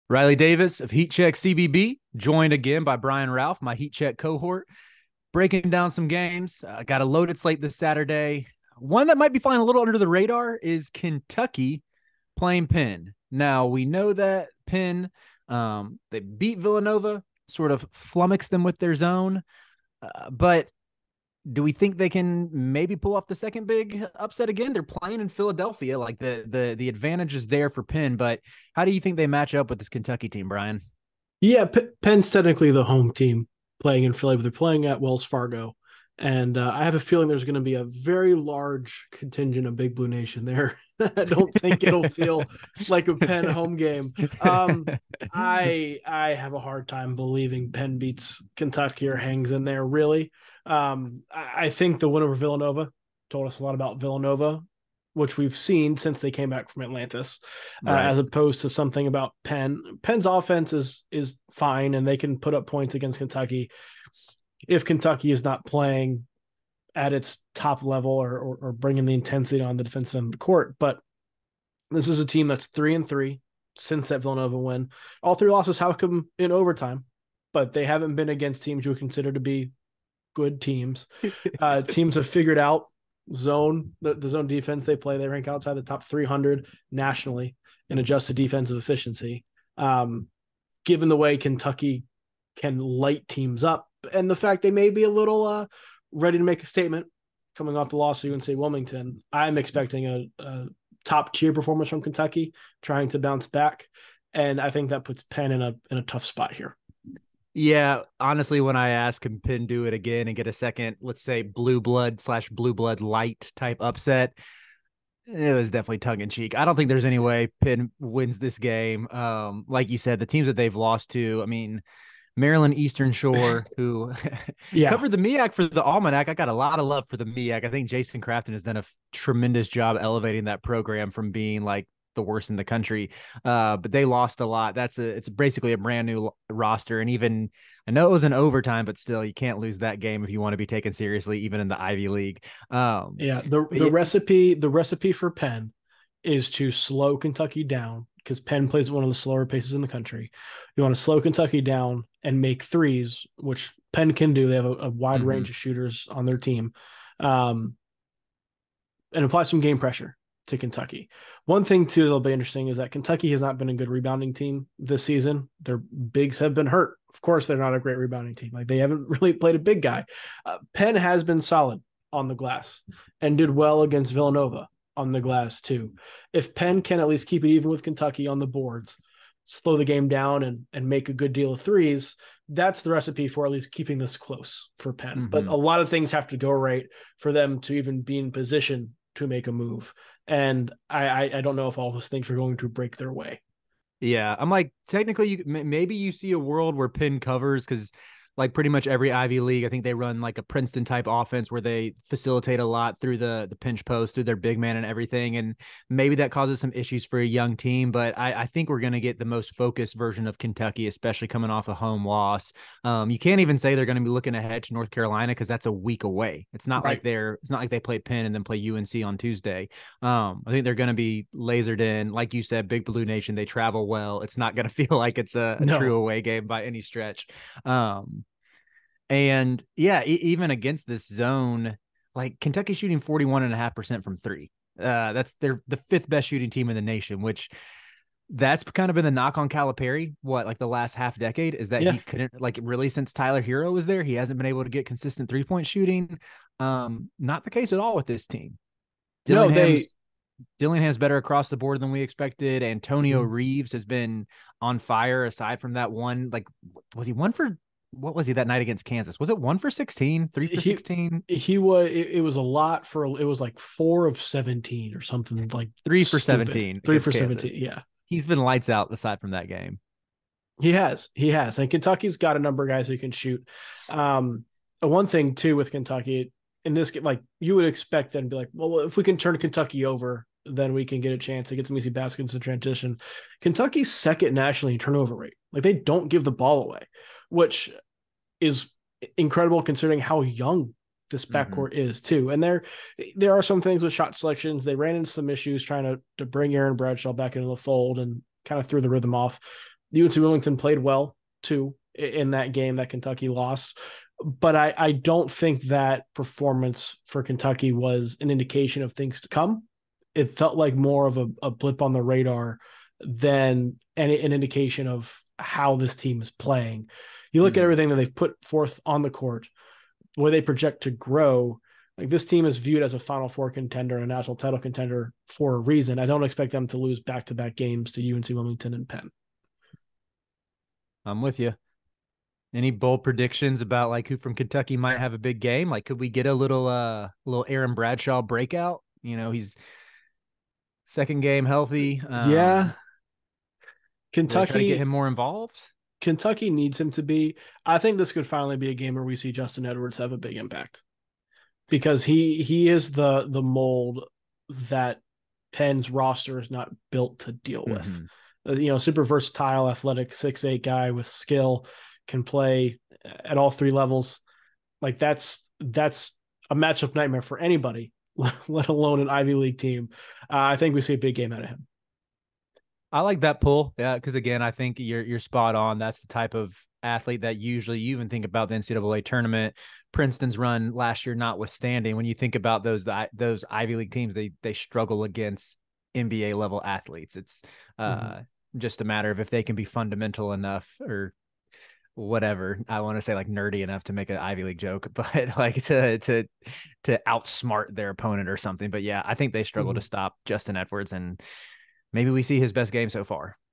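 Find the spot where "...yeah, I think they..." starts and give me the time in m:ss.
6:38.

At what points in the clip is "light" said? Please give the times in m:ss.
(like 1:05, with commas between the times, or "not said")
1:32, 1:53, 4:28.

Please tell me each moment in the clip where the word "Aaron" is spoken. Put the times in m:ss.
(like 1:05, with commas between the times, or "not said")
4:56, 5:37.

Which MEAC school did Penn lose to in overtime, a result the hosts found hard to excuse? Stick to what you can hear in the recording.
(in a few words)
Maryland Eastern Shore.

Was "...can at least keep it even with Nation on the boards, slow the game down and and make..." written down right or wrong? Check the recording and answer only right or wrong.
wrong.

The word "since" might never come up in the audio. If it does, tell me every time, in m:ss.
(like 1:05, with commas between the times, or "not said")
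0:55, 1:13, 4:02.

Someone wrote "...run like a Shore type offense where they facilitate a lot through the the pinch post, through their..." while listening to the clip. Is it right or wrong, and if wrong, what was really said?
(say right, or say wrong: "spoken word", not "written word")
wrong: "Princeton", not "Shore".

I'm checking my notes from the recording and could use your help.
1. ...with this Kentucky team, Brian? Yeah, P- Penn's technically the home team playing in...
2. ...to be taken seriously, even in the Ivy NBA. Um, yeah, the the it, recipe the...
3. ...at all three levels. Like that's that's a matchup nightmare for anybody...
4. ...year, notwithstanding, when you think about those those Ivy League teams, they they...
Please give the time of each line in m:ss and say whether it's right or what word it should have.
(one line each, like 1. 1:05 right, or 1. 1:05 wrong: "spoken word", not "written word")
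1. 0:29 right
2. 2:20 wrong: "League", not "NBA"
3. 6:03 right
4. 6:21 right.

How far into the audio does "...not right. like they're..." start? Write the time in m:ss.
3:36.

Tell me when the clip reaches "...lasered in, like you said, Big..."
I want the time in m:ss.
3:41.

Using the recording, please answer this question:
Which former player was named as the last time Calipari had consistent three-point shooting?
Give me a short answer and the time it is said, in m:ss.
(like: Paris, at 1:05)
Tyler Herro, at 4:03.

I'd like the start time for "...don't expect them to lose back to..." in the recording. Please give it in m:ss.
5:26.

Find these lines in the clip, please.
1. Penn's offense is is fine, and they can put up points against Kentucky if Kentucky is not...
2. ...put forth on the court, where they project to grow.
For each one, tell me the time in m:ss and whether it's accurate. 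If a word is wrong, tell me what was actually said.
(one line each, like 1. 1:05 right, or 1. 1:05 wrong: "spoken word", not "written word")
1. 1:00 right
2. 5:18 right.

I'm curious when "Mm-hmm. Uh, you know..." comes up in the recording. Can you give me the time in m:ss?
5:57.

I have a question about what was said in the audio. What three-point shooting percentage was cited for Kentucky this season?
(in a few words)
41.5%.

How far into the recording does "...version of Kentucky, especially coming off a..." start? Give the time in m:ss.
3:29.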